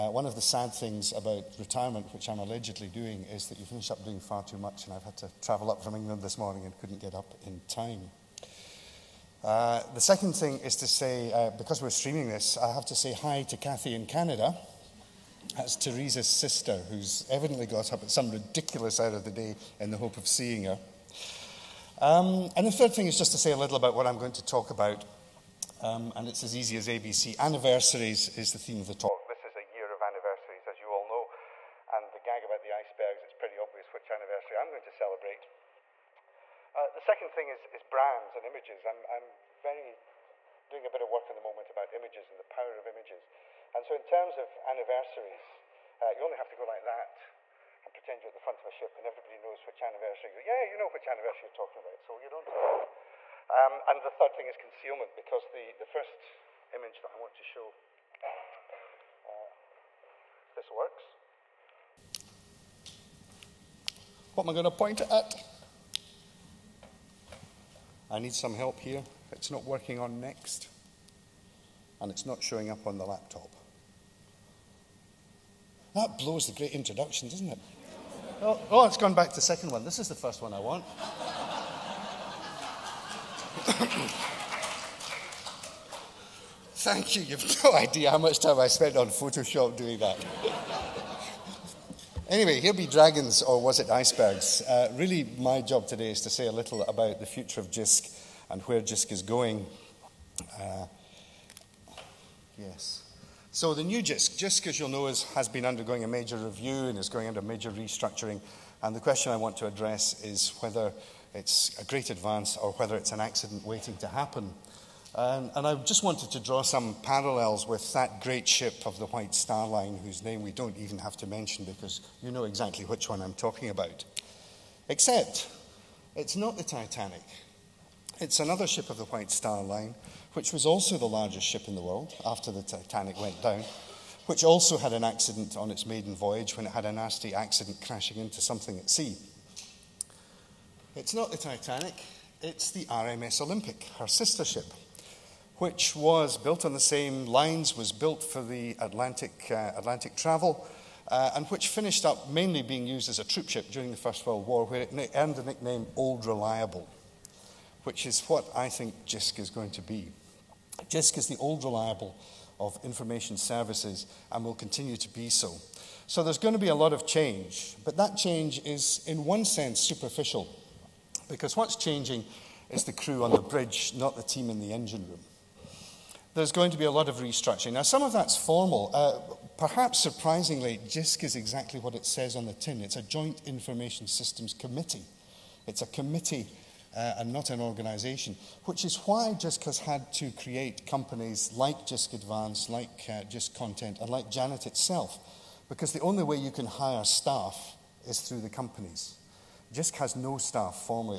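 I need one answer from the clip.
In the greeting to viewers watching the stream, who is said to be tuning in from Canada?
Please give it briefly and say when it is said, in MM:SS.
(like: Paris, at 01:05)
Kathy, at 00:13.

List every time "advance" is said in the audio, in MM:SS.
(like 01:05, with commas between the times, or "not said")
01:52, 03:12.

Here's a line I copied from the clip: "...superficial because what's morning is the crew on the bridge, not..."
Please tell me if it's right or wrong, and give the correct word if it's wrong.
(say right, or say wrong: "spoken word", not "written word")
wrong: "changing", not "morning".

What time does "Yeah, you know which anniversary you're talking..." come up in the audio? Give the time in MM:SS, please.
00:50.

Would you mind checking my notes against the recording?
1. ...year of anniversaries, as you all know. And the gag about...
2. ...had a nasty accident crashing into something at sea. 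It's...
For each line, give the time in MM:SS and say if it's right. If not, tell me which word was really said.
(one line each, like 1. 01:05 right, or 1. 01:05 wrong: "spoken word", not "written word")
1. 00:29 right
2. 02:16 right.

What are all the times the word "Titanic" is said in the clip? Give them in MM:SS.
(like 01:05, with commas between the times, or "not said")
02:06, 02:12, 02:21.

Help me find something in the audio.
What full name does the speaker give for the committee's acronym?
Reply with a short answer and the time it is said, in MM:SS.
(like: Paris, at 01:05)
Joint Information Systems Committee, at 03:03.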